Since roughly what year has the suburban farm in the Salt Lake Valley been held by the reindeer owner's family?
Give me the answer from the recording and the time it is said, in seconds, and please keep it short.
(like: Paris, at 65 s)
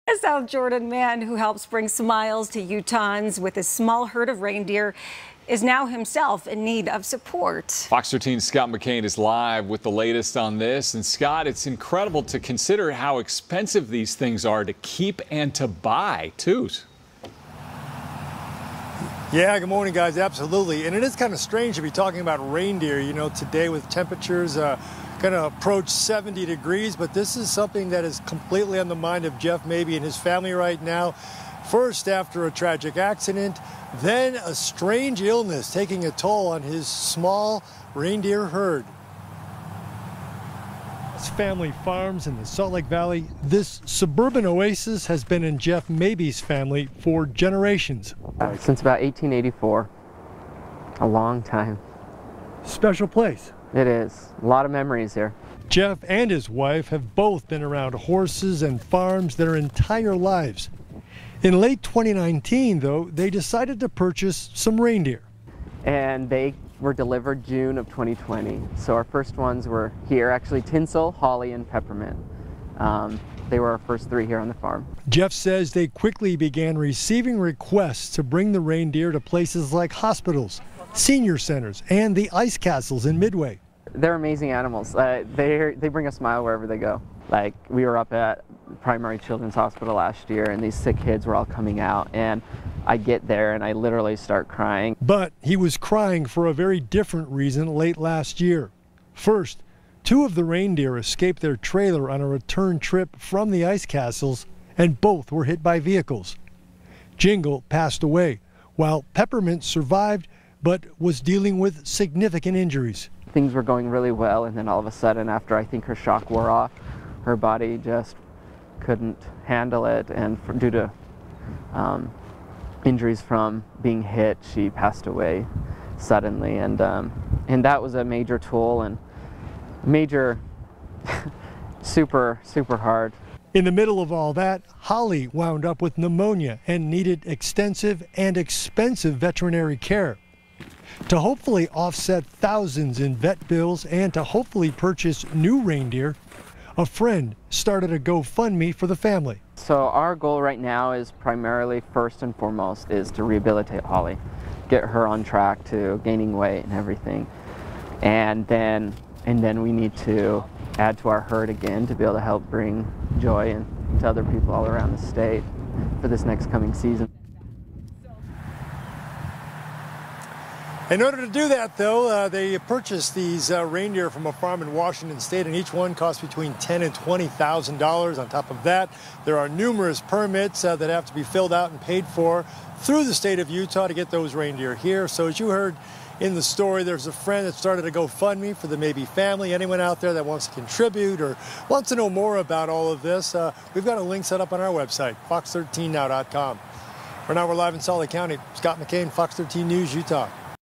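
1884, at 49 s.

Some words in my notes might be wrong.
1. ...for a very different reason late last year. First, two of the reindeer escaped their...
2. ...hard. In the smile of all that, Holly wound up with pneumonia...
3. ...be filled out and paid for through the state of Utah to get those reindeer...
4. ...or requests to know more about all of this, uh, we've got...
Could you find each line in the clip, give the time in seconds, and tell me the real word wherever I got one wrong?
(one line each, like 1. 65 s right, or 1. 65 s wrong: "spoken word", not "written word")
1. 96 s right
2. 132 s wrong: "middle", not "smile"
3. 181 s right
4. 191 s wrong: "wants", not "requests".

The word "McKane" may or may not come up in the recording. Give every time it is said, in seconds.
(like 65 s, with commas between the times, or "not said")
8 s, 198 s.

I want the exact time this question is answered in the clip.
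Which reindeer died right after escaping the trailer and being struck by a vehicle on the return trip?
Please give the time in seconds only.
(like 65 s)
107 s.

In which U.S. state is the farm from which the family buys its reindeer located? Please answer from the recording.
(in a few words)
Washington.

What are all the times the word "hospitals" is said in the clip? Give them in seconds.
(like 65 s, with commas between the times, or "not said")
79 s, 89 s.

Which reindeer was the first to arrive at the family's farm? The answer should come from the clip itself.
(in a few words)
Tinsel.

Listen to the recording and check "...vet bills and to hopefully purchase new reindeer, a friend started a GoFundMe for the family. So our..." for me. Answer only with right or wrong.
right.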